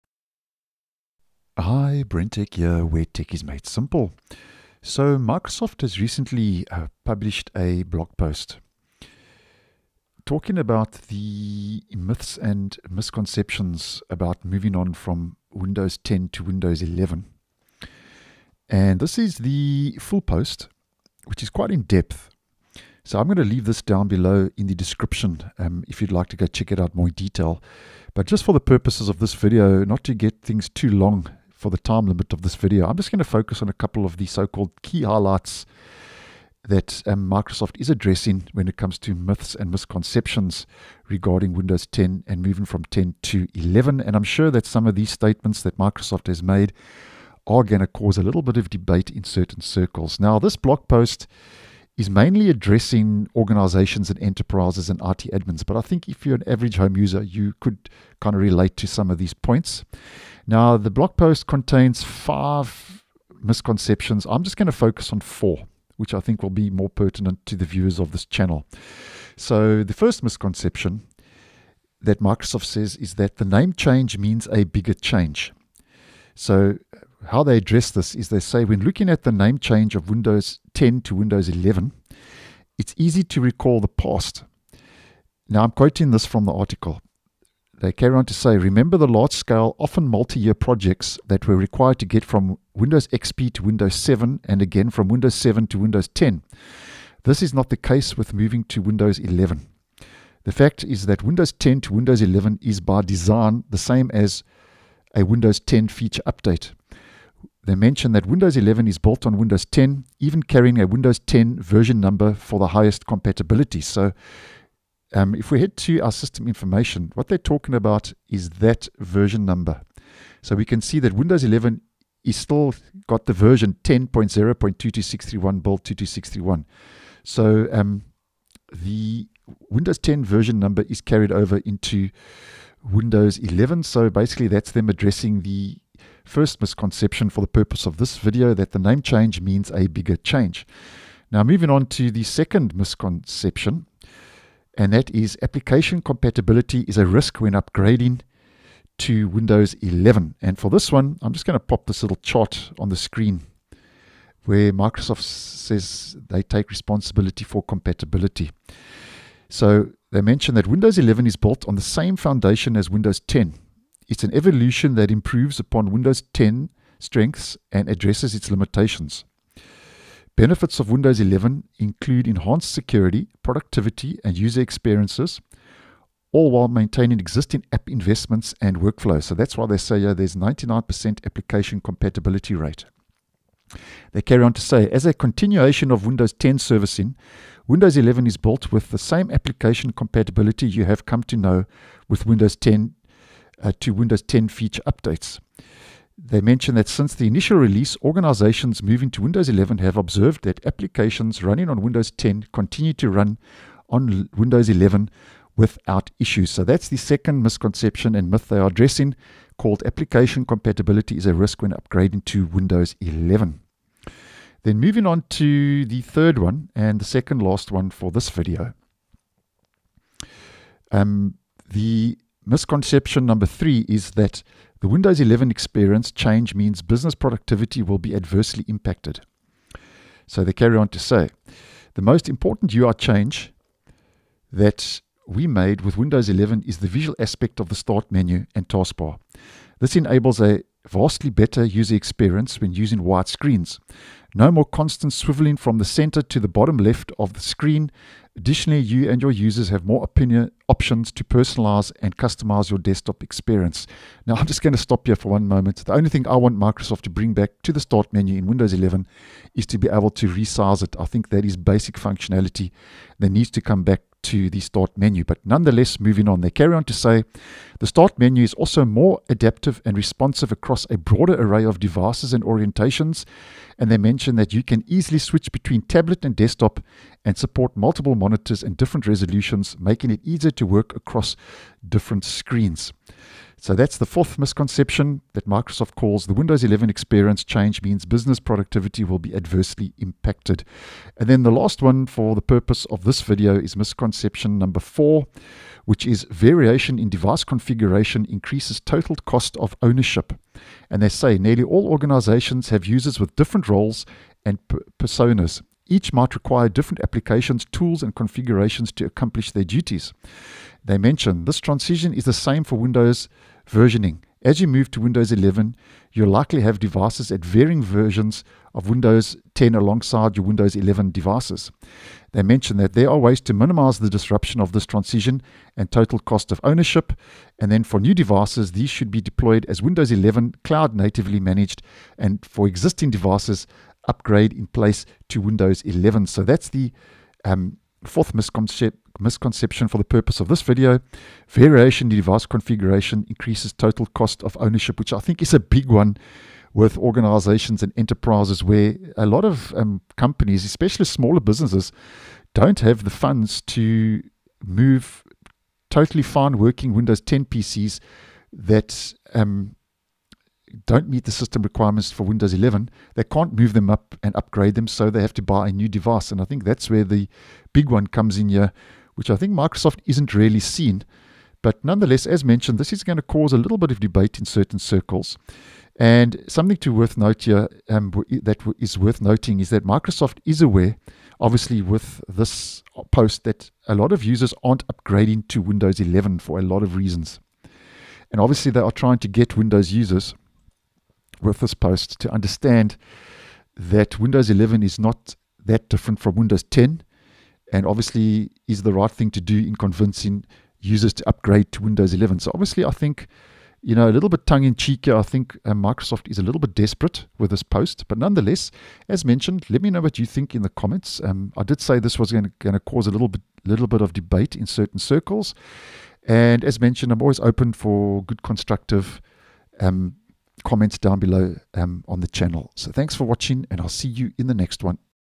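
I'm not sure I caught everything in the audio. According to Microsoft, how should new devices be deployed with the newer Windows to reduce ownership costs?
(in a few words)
Cloud natively managed.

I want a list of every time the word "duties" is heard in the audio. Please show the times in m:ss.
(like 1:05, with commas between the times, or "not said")
5:09.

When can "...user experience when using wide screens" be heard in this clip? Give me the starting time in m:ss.
4:01.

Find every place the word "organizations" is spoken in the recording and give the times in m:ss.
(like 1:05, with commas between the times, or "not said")
0:53, 3:18, 5:01, 5:46.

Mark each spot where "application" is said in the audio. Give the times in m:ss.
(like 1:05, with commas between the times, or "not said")
2:25, 3:01, 3:09, 3:20, 3:29, 5:07.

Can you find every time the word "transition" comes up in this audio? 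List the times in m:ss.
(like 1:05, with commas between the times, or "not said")
5:11, 5:24.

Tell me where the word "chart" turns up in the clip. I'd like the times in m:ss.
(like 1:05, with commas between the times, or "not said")
2:32.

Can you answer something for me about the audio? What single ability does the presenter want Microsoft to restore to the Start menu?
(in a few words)
Resize it.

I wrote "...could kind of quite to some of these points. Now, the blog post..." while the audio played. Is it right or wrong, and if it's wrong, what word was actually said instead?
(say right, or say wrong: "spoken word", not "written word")
wrong: "relate", not "quite".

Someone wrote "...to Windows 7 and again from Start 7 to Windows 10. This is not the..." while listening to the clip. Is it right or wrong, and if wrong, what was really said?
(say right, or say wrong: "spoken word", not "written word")
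wrong: "Windows", not "Start".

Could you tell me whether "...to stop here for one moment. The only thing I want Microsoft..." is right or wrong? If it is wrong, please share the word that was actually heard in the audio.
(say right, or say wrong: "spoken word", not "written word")
right.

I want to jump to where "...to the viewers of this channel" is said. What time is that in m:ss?
1:07.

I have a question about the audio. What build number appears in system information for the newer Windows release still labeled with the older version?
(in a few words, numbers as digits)
22631.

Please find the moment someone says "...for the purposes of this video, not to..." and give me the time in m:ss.
0:28.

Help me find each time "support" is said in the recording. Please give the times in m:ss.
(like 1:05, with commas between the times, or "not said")
4:37.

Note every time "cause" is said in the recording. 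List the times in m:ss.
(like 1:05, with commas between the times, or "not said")
0:47, 6:13, 6:52.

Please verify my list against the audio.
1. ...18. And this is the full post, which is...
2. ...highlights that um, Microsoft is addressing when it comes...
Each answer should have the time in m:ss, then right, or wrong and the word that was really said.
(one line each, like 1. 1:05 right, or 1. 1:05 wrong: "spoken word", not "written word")
1. 0:16 wrong: "11", not "18"
2. 0:35 right.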